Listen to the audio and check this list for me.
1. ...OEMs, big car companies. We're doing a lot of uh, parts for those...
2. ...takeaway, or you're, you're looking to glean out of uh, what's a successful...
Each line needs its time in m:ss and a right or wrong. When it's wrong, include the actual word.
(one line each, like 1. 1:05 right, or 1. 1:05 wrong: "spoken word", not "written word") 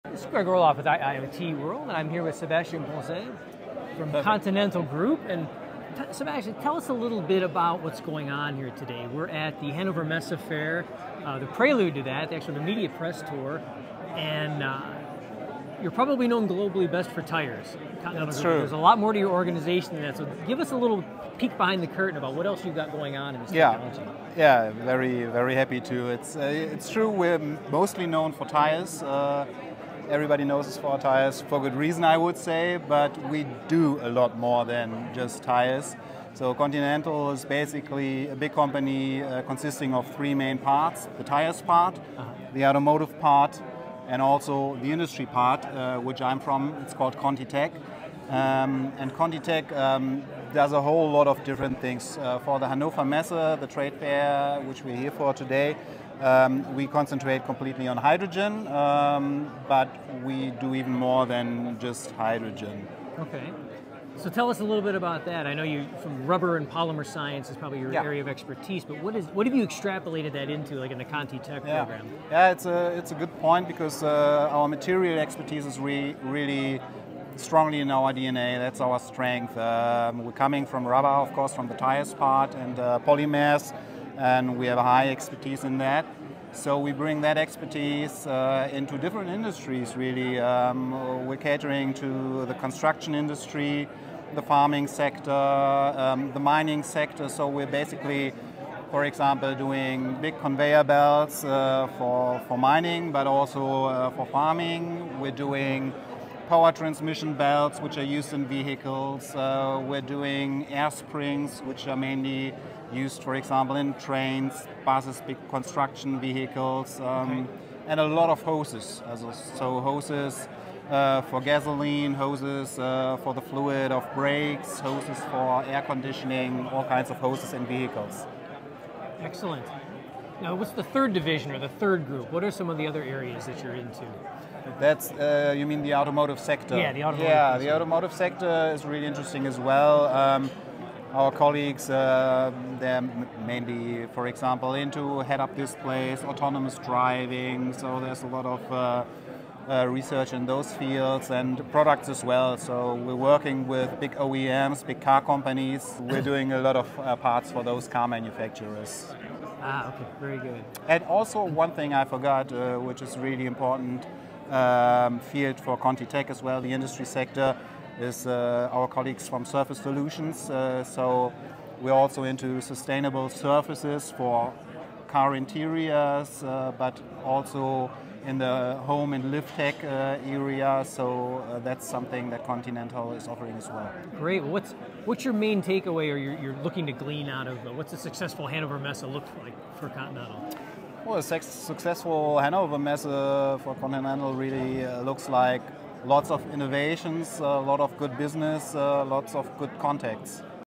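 1. 2:34 right
2. 3:05 right.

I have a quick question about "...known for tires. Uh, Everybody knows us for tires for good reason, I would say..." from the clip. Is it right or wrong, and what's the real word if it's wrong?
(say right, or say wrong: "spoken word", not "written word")
right.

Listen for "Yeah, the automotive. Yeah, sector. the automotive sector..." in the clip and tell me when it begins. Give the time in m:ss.
2:16.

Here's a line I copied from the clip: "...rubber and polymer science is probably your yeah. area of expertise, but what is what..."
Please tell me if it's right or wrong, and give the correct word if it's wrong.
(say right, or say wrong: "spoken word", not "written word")
right.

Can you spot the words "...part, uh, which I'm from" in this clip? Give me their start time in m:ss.
0:45.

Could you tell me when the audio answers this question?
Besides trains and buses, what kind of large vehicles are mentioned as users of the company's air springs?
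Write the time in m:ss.
1:55.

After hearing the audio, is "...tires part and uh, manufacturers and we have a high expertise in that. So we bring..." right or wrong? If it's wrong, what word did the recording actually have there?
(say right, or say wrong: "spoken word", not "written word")
wrong: "polymers", not "manufacturers".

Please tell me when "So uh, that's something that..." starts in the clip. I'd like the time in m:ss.
3:00.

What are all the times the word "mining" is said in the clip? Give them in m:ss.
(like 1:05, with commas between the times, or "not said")
1:36, 1:42.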